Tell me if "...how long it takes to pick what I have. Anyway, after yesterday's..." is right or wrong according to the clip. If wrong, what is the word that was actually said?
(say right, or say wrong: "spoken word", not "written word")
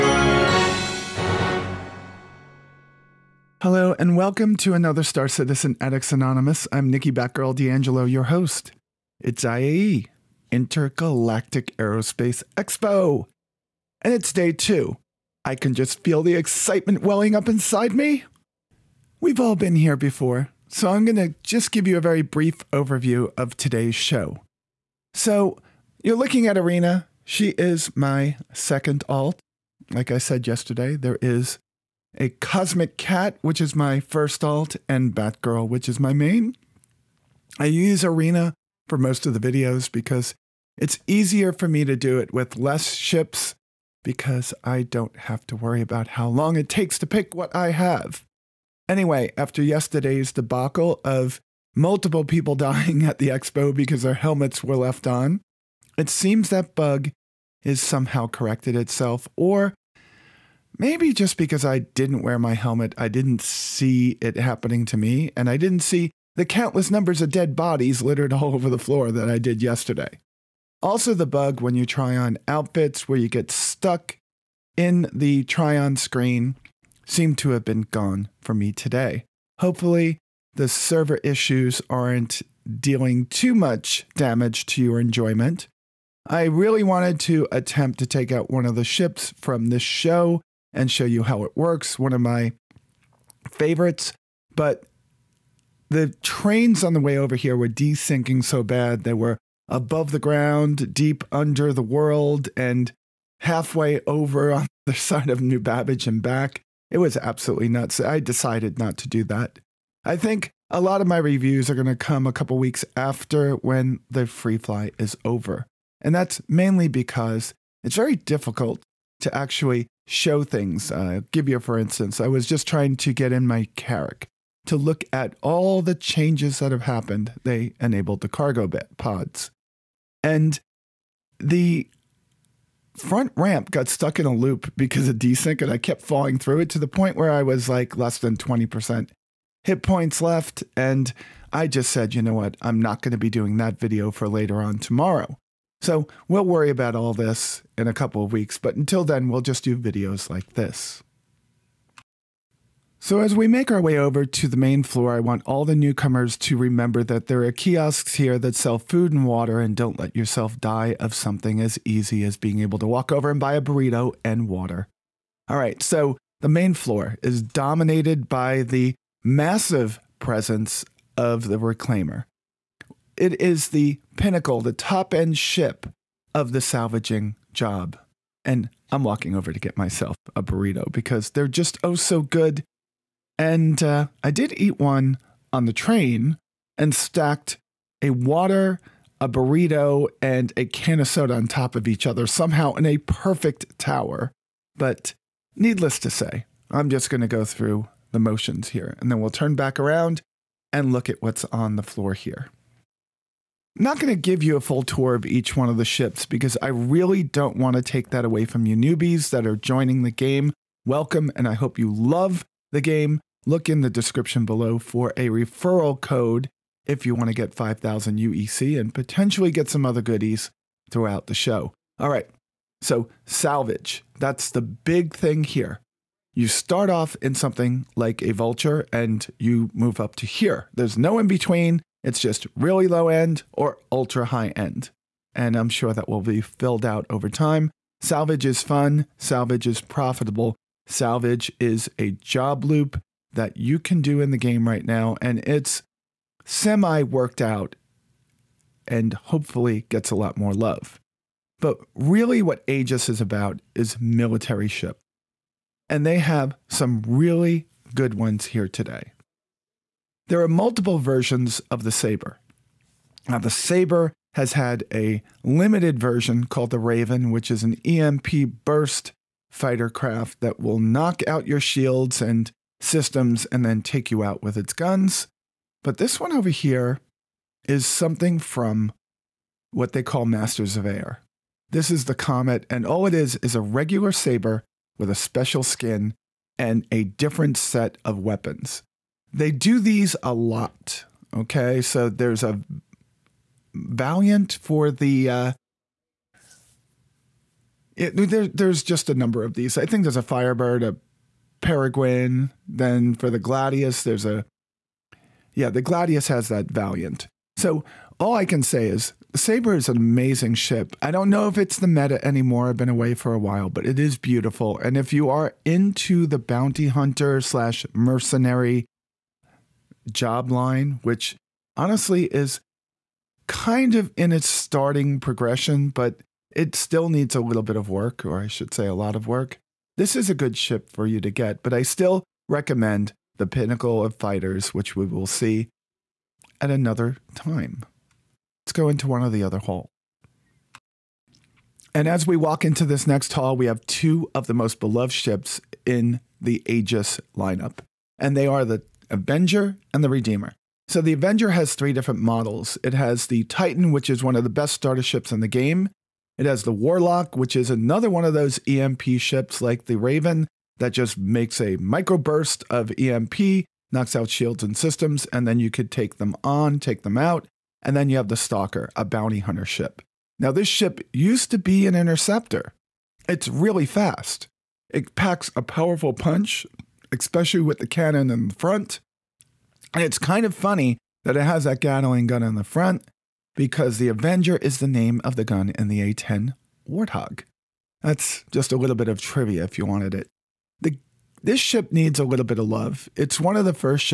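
right.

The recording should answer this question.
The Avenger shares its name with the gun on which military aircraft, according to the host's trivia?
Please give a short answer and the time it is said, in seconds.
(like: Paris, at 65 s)
A-10 Warthog, at 386 s.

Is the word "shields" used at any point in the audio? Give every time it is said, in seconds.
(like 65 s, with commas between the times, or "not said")
271 s, 364 s.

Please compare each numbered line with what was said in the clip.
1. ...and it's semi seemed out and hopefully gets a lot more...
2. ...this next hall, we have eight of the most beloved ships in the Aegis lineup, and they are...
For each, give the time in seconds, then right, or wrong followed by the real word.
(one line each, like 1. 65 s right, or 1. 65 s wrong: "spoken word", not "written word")
1. 245 s wrong: "worked", not "seemed"
2. 342 s wrong: "two", not "eight".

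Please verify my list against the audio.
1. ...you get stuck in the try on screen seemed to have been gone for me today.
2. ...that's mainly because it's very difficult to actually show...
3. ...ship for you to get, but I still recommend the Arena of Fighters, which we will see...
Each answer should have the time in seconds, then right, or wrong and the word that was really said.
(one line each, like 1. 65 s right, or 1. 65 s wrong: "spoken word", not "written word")
1. 73 s right
2. 116 s right
3. 330 s wrong: "Pinnacle", not "Arena".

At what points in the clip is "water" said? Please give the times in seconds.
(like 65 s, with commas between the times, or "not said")
159 s, 164 s, 188 s.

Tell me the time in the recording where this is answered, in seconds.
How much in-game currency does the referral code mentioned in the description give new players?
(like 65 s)
217 s.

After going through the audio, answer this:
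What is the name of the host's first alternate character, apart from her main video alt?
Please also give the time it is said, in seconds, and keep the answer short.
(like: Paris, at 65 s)
Cosmic Cat, at 32 s.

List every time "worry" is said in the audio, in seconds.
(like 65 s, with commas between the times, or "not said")
45 s, 146 s.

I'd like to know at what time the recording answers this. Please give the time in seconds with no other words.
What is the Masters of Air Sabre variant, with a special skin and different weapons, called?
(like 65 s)
282 s.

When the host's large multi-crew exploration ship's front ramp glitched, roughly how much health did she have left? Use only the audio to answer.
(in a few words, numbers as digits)
less than 20%.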